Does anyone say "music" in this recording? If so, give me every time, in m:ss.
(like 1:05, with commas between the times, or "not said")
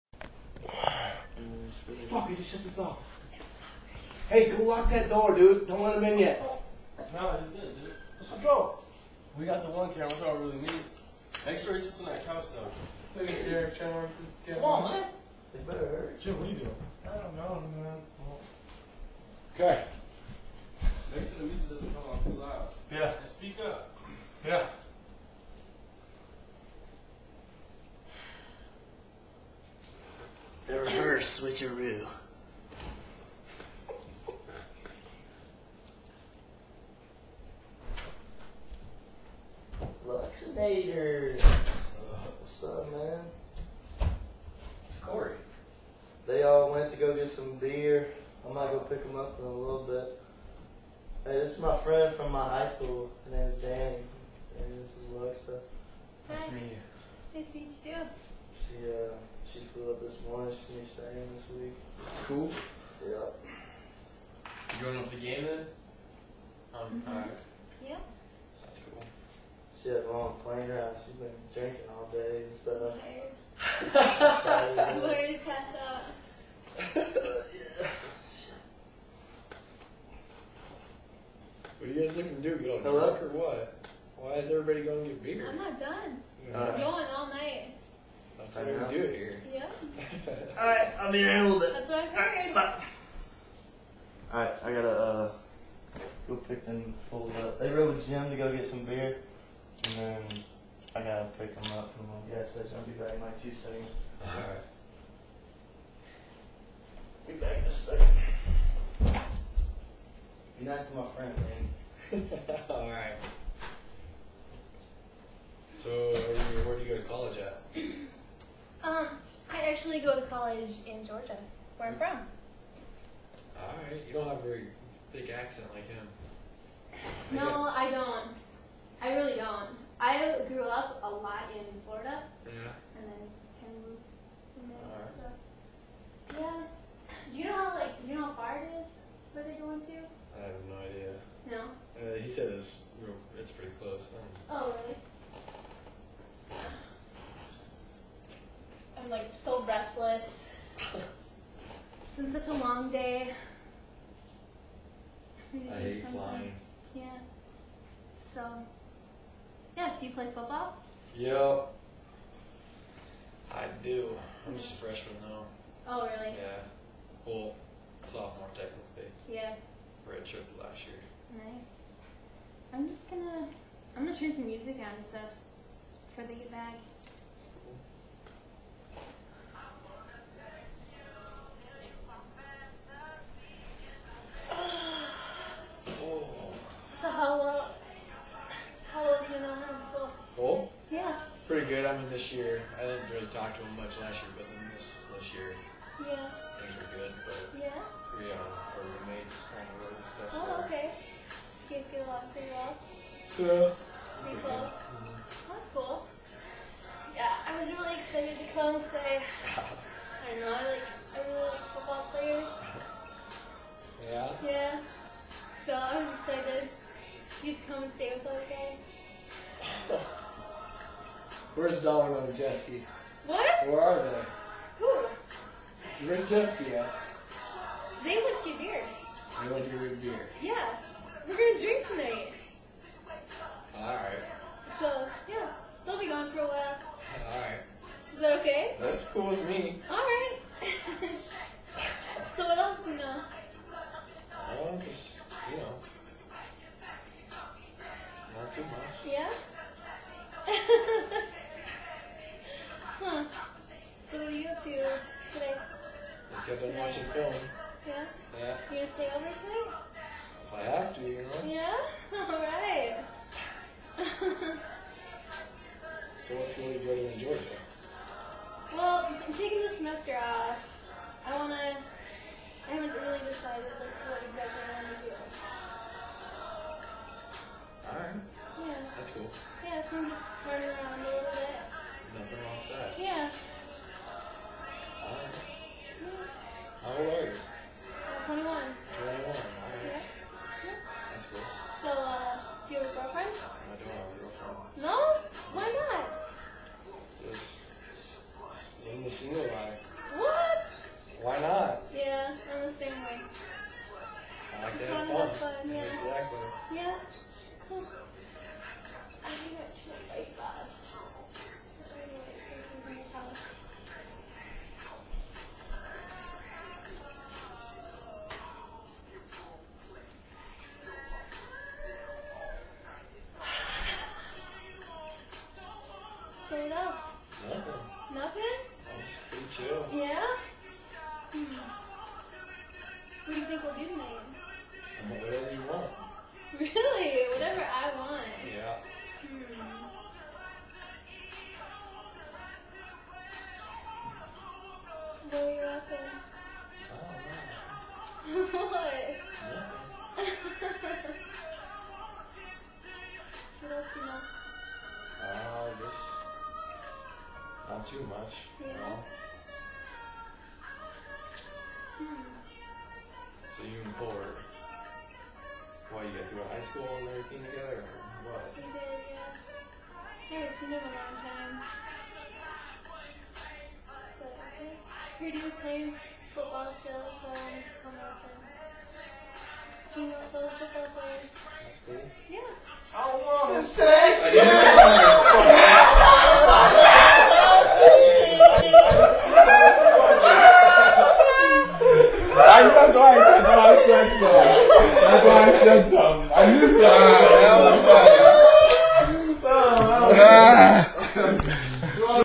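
0:21, 2:54.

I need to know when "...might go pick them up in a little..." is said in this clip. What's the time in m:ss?
0:48.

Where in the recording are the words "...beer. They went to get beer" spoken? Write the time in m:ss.
3:48.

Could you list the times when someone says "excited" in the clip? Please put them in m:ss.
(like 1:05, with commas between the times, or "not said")
3:27, 3:36.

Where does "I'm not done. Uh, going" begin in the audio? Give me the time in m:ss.
1:25.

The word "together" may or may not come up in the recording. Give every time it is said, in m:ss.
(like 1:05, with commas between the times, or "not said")
6:07.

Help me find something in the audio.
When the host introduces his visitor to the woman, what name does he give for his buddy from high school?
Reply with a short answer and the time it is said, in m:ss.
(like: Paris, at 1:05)
Danny, at 0:53.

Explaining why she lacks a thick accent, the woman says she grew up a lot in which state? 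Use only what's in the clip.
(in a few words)
Florida.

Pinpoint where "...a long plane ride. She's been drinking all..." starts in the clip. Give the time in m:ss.
1:10.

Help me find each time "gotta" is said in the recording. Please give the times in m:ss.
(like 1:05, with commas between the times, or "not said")
1:34, 1:41.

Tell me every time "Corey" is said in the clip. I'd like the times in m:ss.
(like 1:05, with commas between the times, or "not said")
0:45.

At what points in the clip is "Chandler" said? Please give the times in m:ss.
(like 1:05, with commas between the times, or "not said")
0:13.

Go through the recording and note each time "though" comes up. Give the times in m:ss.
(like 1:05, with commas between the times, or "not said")
0:12, 2:45.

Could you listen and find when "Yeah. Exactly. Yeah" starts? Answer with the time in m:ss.
5:05.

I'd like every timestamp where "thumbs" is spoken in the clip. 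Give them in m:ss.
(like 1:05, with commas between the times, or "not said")
not said.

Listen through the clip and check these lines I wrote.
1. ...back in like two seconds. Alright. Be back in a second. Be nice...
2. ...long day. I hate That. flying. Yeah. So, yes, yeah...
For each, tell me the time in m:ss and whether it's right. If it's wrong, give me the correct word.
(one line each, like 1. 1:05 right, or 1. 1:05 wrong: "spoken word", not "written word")
1. 1:42 right
2. 2:32 wrong: "Something", not "That".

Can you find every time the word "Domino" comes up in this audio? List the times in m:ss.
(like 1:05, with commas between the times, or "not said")
3:41.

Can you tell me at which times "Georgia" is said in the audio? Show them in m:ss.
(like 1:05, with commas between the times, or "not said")
2:01, 4:27.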